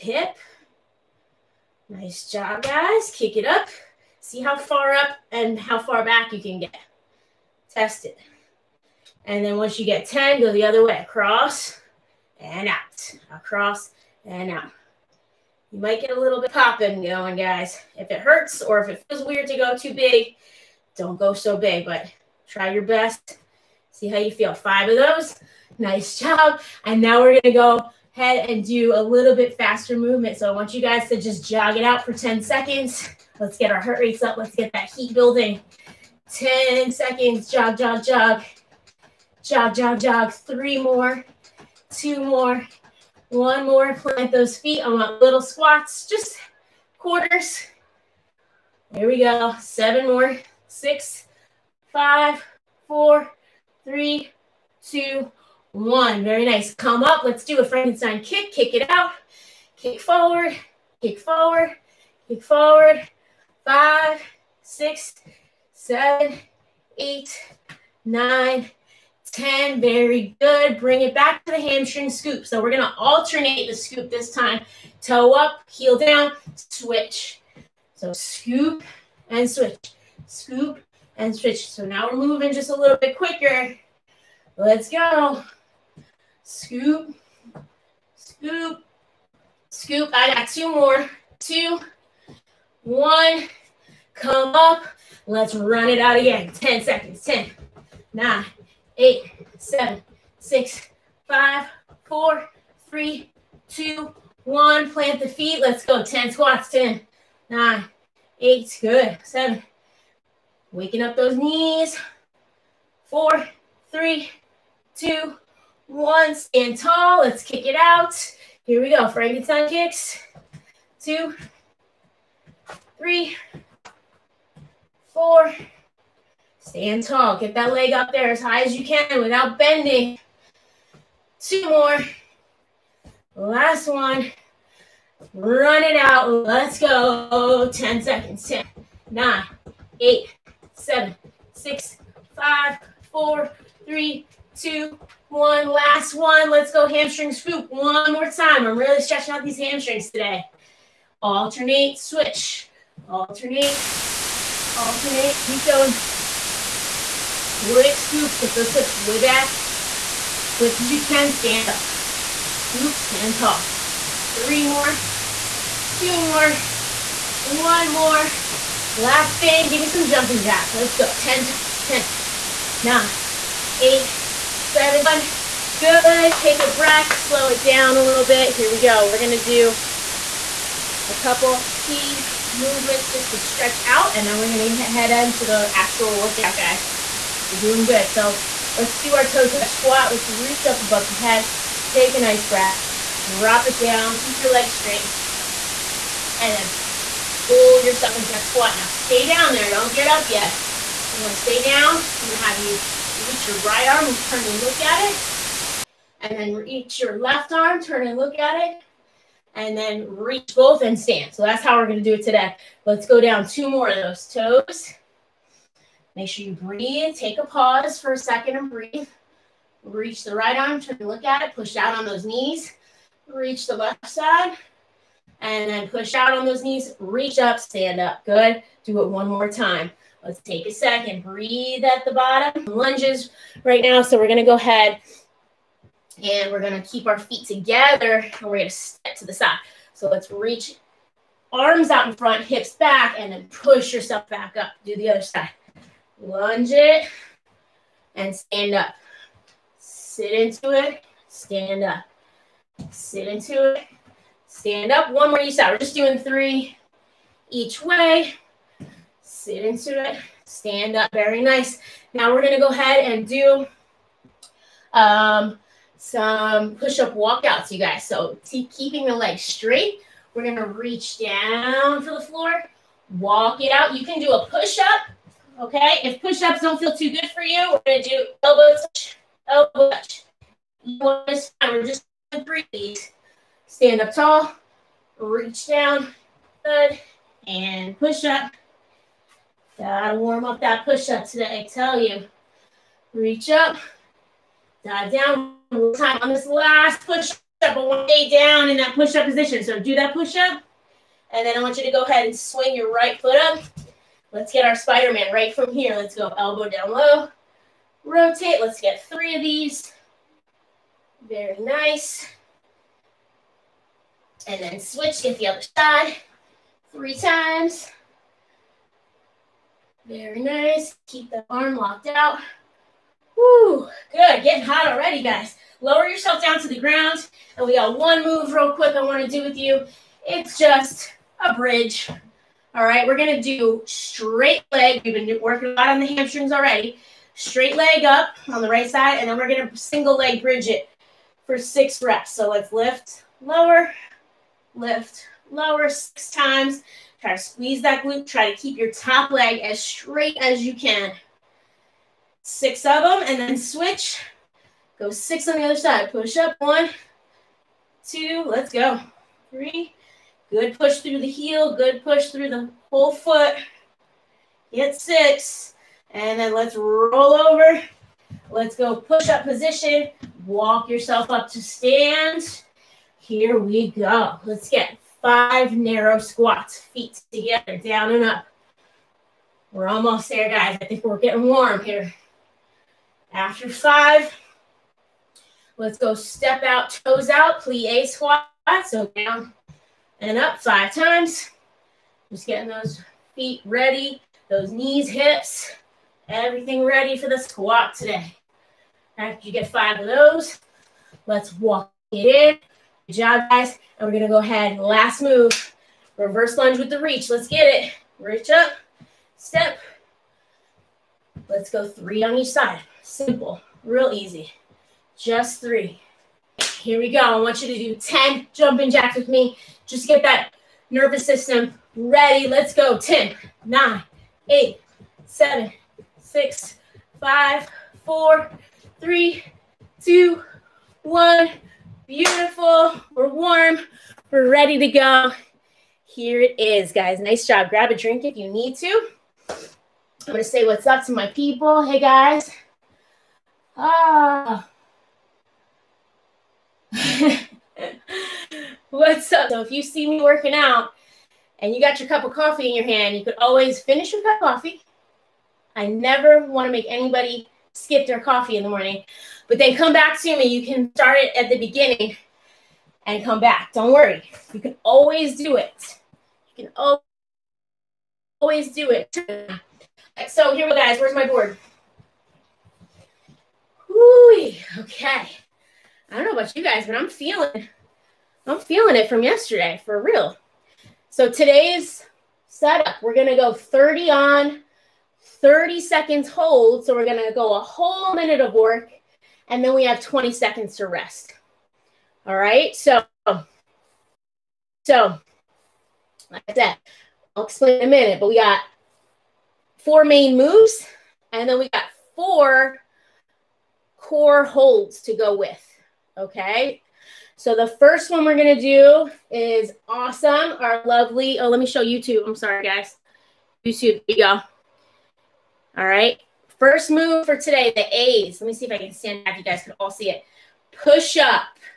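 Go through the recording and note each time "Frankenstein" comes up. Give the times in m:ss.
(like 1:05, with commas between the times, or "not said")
0:57, 1:59.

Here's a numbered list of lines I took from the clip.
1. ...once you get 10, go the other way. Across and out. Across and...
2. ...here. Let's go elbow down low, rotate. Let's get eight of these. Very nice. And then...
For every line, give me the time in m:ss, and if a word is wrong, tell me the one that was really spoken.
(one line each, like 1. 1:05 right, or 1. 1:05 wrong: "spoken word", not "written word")
1. 0:09 right
2. 5:05 wrong: "three", not "eight".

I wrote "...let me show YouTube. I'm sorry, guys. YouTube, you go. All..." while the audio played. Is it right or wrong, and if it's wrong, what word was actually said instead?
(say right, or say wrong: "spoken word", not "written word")
right.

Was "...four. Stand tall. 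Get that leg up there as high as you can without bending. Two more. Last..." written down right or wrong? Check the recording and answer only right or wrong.
right.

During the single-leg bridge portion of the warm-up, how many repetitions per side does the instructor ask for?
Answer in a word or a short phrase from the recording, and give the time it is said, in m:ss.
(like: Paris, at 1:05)
6, at 5:41.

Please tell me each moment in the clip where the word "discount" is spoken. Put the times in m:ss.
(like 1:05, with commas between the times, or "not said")
not said.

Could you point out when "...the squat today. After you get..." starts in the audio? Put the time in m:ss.
6:37.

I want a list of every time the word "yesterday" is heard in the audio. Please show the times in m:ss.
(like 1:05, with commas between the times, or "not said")
7:59.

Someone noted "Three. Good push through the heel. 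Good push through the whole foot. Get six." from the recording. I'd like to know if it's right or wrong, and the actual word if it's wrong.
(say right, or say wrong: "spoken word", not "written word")
right.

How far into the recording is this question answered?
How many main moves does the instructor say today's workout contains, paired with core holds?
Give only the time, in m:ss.
8:19.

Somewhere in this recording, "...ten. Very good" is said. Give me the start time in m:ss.
1:09.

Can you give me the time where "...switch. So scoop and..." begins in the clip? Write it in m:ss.
1:16.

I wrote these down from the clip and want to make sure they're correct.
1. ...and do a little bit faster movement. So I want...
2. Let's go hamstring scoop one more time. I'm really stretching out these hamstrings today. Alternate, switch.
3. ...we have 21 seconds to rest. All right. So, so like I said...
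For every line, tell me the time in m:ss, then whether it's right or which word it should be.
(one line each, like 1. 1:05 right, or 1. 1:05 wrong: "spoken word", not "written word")
1. 0:28 right
2. 2:26 right
3. 8:09 wrong: "20", not "21".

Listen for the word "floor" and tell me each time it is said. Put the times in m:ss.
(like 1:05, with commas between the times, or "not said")
4:32.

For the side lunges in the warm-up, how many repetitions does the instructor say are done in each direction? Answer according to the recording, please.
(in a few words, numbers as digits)
3.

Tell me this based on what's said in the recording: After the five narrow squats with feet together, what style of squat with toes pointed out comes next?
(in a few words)
plie squat.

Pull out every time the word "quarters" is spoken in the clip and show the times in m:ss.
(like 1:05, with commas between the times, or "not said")
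0:46.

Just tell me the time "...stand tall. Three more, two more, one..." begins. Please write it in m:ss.
2:42.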